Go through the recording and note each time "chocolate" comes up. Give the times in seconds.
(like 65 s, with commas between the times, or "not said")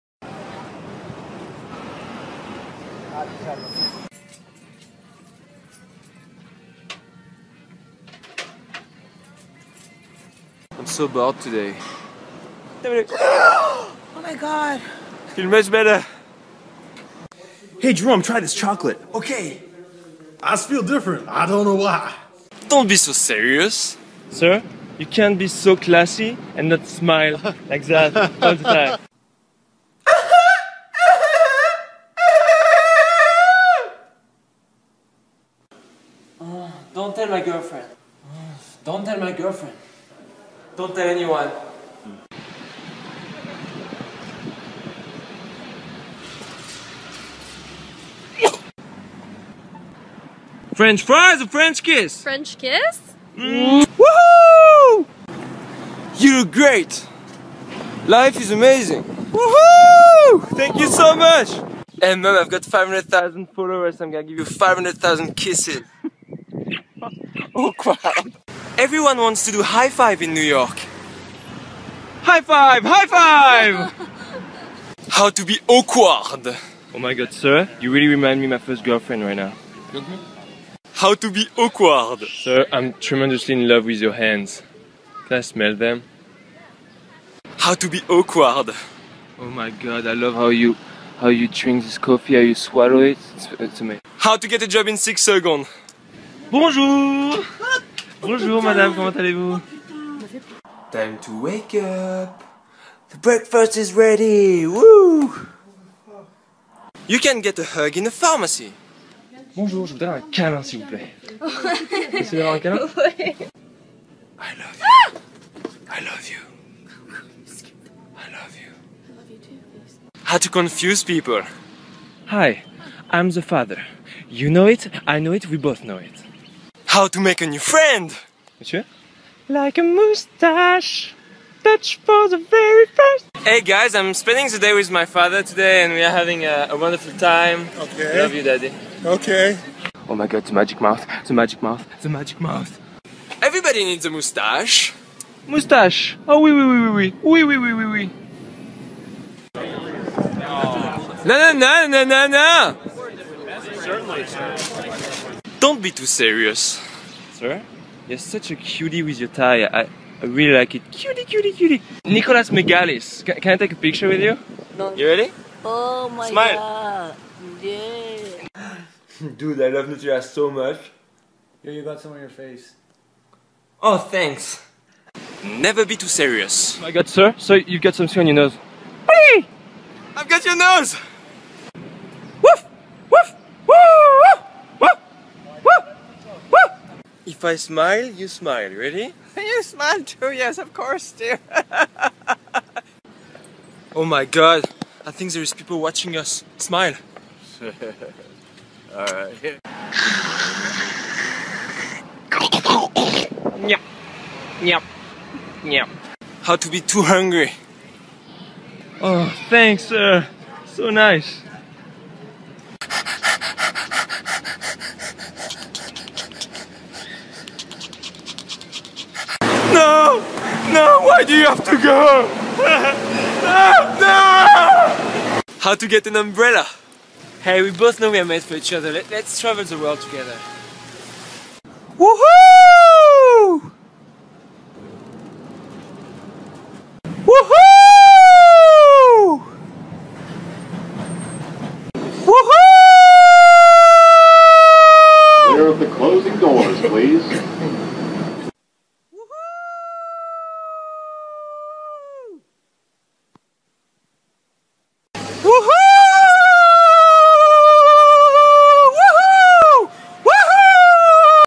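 18 s.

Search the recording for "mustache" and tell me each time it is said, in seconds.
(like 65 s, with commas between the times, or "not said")
129 s, 144 s.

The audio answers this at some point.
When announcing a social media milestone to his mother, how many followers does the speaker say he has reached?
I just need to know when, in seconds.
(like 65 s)
62 s.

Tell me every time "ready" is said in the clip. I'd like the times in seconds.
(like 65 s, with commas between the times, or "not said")
103 s, 165 s, 188 s.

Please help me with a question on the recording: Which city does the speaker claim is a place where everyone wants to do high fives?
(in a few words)
New York.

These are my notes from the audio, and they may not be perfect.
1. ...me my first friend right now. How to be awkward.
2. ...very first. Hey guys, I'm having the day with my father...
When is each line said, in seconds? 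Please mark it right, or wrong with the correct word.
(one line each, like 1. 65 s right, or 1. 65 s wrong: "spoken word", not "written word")
1. 78 s wrong: "girlfriend", not "friend"
2. 132 s wrong: "spending", not "having".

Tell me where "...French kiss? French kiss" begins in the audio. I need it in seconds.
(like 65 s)
51 s.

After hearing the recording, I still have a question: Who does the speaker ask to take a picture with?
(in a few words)
Nicholas Megalis.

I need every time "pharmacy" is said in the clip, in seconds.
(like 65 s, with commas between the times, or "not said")
108 s.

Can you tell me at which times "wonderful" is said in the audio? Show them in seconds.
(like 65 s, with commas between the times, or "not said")
136 s.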